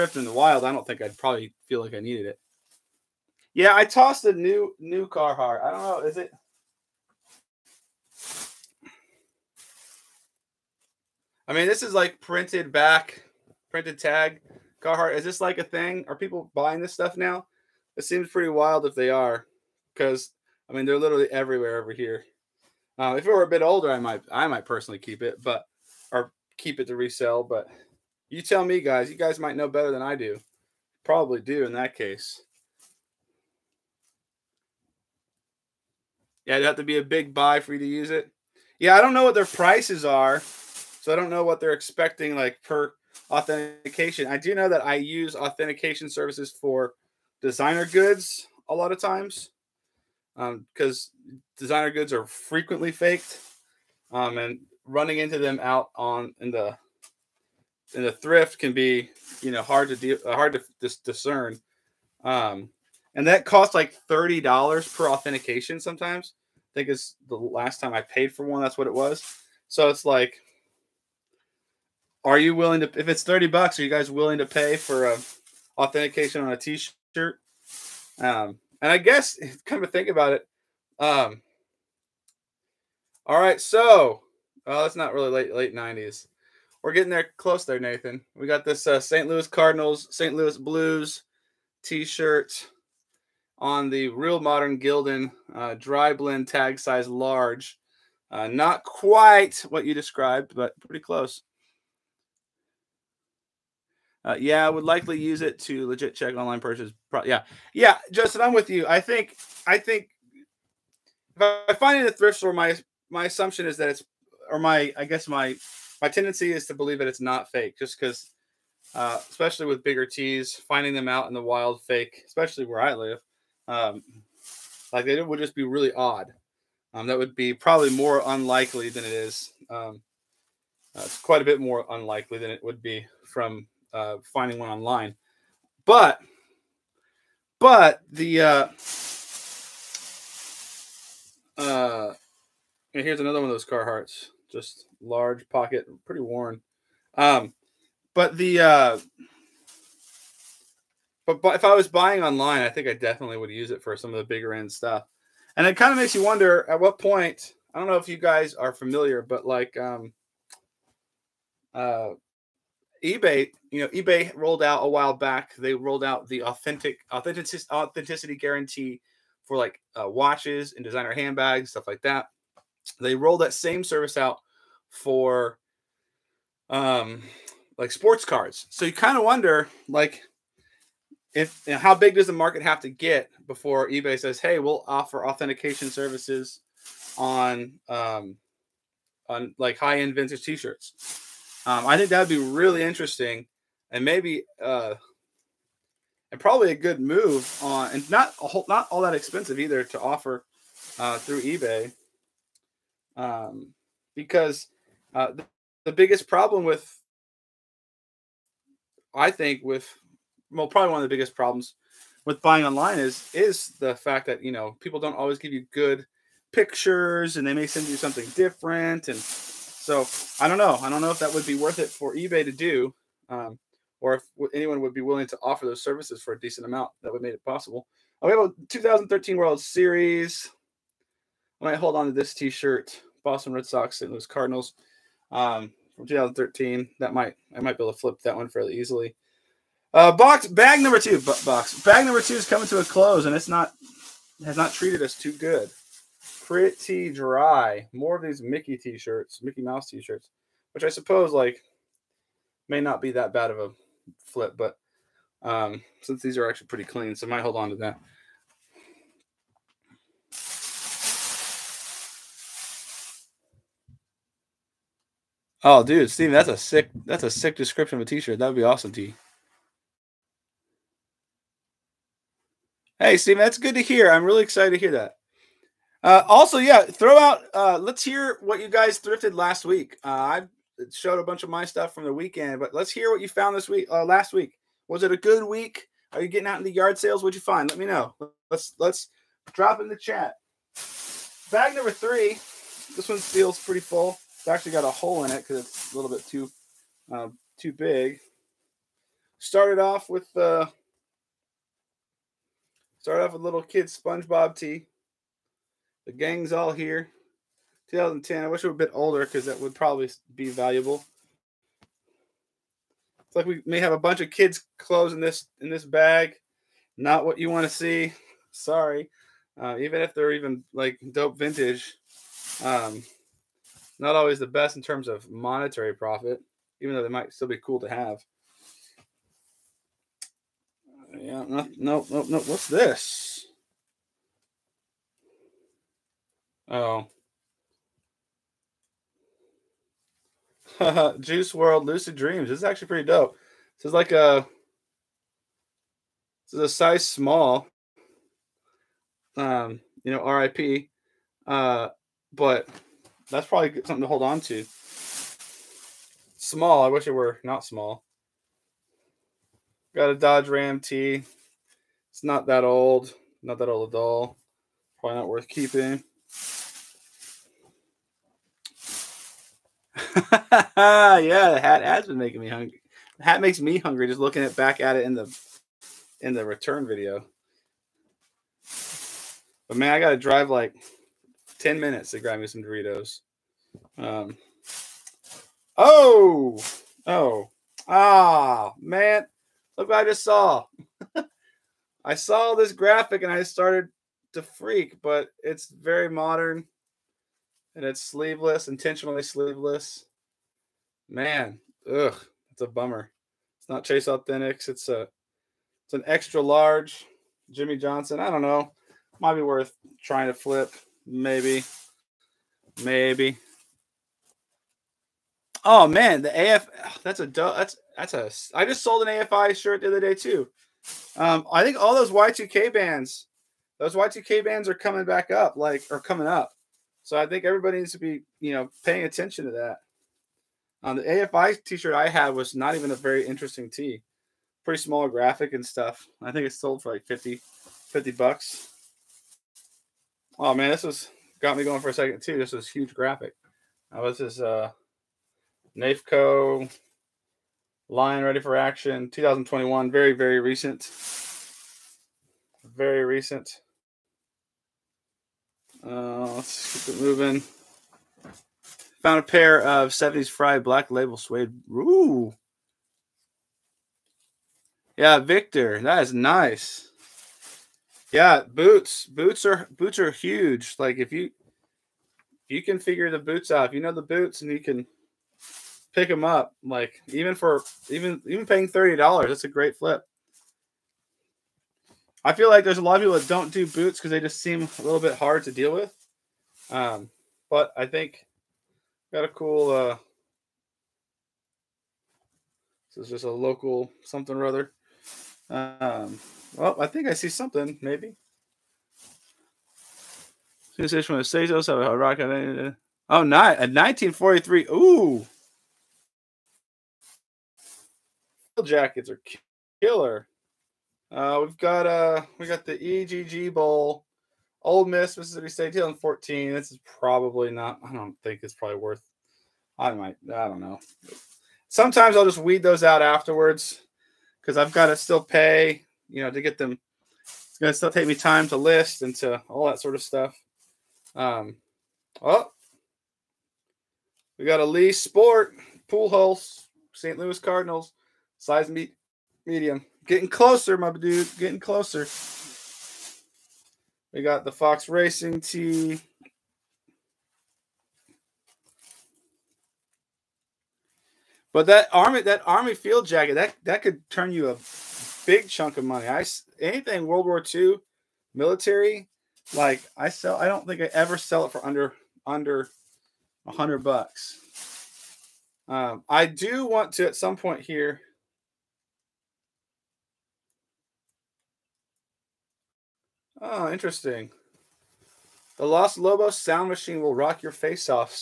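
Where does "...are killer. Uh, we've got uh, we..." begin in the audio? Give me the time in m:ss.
8:29.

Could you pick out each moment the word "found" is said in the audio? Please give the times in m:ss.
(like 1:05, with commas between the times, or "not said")
4:43, 7:39.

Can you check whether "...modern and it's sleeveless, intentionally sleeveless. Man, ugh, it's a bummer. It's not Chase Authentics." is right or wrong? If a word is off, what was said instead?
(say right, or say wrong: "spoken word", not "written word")
right.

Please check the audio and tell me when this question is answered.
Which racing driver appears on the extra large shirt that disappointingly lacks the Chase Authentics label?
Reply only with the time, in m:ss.
6:47.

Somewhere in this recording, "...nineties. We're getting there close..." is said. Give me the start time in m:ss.
1:25.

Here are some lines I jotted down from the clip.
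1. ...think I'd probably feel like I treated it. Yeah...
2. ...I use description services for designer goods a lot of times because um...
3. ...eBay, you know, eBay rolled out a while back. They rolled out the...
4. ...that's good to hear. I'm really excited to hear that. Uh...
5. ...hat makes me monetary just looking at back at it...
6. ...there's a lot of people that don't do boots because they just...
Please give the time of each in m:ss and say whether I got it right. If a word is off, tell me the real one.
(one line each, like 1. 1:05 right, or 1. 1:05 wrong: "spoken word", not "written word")
1. 0:00 wrong: "needed", not "treated"
2. 0:44 wrong: "authentication", not "description"
3. 2:43 right
4. 4:33 right
5. 6:13 wrong: "hungry", not "monetary"
6. 8:02 right.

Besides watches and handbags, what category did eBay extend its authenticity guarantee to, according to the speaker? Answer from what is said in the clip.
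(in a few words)
sports cards.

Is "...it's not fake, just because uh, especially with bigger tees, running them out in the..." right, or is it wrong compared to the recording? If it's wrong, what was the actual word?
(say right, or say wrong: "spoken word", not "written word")
wrong: "finding", not "running".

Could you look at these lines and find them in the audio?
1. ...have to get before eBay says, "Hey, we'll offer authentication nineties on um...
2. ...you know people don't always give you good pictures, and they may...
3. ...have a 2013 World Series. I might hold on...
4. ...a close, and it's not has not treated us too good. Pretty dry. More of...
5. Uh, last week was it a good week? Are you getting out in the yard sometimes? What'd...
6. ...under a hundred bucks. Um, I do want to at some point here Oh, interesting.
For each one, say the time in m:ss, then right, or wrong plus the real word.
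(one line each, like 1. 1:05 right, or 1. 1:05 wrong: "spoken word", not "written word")
1. 3:02 wrong: "services", not "nineties"
2. 3:34 right
3. 3:48 right
4. 4:02 right
5. 4:43 wrong: "sales", not "sometimes"
6. 9:22 right.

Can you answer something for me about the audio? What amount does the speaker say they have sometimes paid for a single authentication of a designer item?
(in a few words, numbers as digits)
$30.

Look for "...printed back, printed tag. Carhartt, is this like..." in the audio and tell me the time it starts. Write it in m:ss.
0:12.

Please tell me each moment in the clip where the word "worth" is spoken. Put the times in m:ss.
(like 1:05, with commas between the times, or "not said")
3:41, 6:05, 6:49, 8:38.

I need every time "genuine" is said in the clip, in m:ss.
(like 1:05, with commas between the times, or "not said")
not said.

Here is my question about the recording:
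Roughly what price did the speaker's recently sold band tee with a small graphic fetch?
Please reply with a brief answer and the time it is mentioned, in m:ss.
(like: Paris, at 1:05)
$50, at 7:17.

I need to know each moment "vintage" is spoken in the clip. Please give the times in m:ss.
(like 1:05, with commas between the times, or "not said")
3:10, 5:21.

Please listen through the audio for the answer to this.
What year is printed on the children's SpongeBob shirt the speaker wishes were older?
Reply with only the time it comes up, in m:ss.
5:07.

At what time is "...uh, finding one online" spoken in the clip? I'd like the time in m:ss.
2:13.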